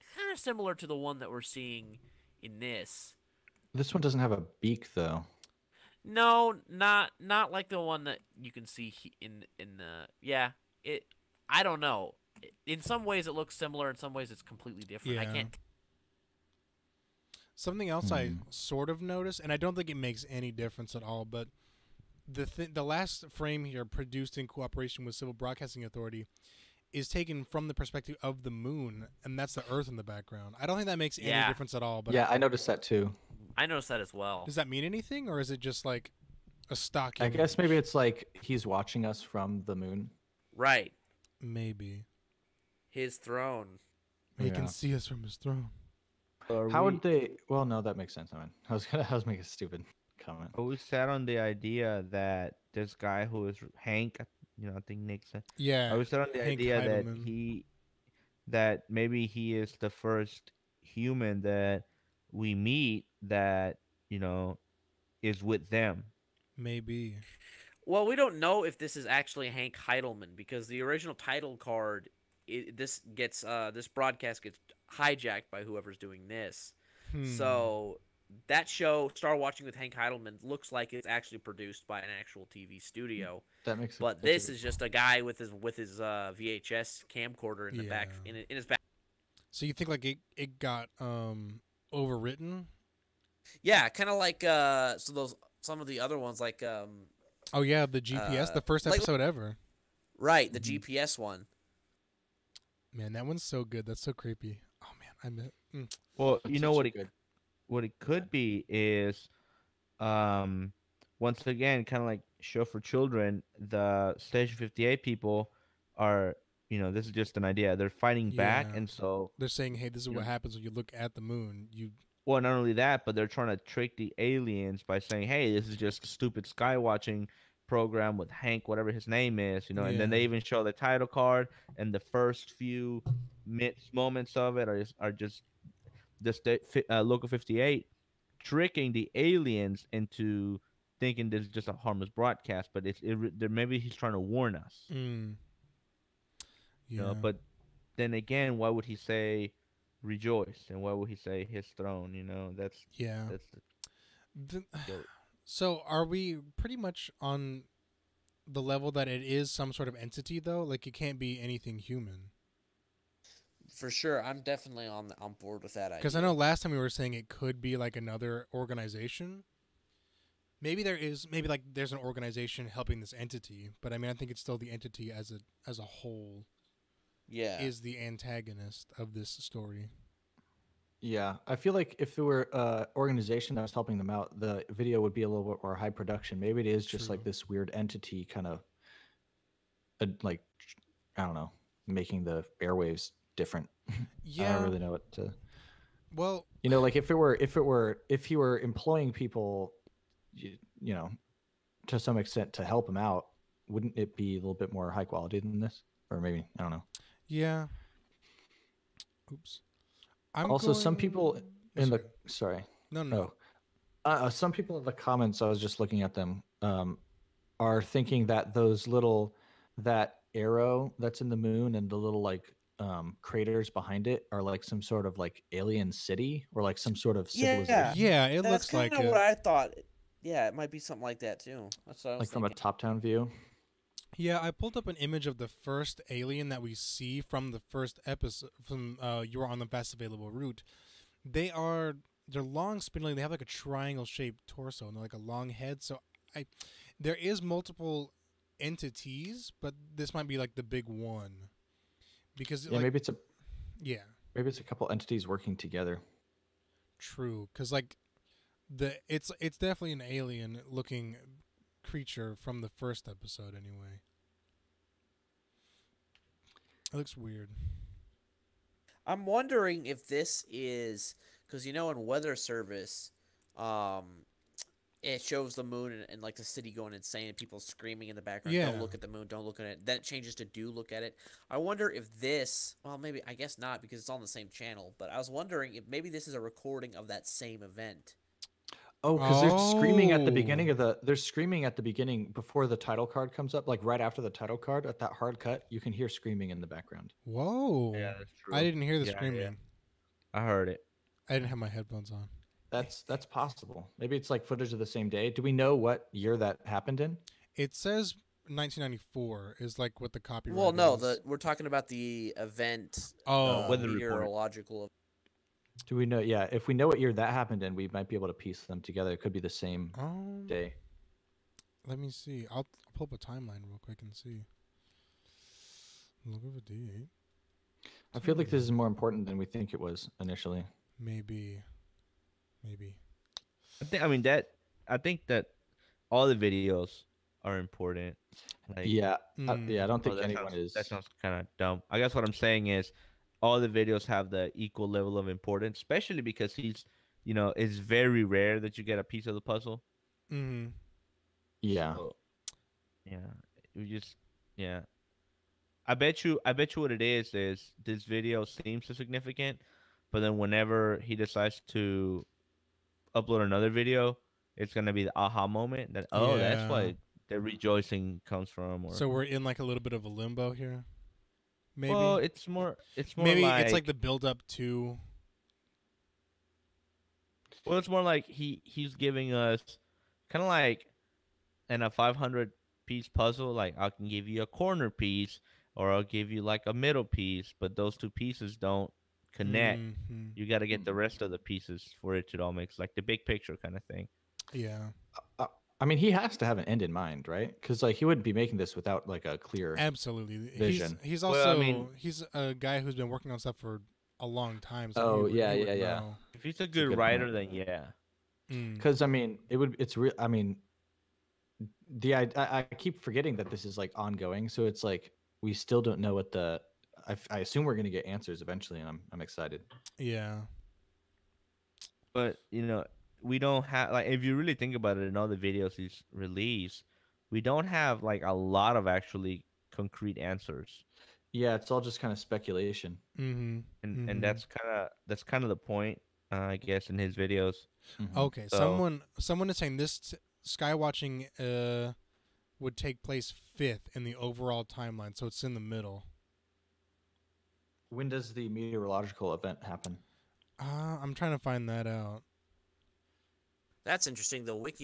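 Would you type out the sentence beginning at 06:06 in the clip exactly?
that's why the rejoicing comes from.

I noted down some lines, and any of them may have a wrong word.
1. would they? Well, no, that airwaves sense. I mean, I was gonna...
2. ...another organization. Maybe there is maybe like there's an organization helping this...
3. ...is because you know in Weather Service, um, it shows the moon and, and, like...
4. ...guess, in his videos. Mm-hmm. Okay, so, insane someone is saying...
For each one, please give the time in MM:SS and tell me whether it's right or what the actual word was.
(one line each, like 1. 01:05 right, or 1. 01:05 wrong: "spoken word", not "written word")
1. 00:46 wrong: "makes", not "airwaves"
2. 02:47 right
3. 04:30 right
4. 07:16 wrong: "someone", not "insane".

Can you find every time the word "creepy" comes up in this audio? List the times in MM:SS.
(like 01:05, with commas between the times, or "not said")
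01:44.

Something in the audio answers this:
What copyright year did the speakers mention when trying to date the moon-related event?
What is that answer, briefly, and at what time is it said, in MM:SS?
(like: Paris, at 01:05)
1994, at 05:08.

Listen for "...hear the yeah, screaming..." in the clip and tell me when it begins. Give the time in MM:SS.
04:58.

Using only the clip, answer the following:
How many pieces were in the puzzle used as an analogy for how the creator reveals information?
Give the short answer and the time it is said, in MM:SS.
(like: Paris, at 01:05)
500, at 06:21.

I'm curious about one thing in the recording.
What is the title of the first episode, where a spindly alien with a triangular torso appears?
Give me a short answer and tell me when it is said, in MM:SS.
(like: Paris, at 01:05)
You Are on the Best Available Route, at 03:59.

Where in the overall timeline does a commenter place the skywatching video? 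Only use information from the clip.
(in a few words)
fifth.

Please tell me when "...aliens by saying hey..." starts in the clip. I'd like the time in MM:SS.
02:04.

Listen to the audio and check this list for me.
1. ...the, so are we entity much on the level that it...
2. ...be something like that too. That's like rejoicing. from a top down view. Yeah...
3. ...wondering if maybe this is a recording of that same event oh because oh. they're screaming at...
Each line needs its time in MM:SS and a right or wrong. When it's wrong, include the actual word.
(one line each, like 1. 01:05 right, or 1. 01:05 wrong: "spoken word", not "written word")
1. 02:34 wrong: "pretty", not "entity"
2. 03:50 wrong: "thinking", not "rejoicing"
3. 04:45 right.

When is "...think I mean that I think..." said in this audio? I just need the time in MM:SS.
05:33.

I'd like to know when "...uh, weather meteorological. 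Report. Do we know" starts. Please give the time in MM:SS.
05:13.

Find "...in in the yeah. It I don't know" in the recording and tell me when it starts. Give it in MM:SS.
00:09.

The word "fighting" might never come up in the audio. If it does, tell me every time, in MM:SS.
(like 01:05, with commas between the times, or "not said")
01:57.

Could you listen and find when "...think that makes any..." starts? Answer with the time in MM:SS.
00:30.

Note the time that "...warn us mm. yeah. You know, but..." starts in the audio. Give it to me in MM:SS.
02:24.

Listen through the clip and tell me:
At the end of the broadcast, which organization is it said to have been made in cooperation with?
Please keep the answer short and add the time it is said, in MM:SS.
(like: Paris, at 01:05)
Civil Broadcasting Authority, at 00:25.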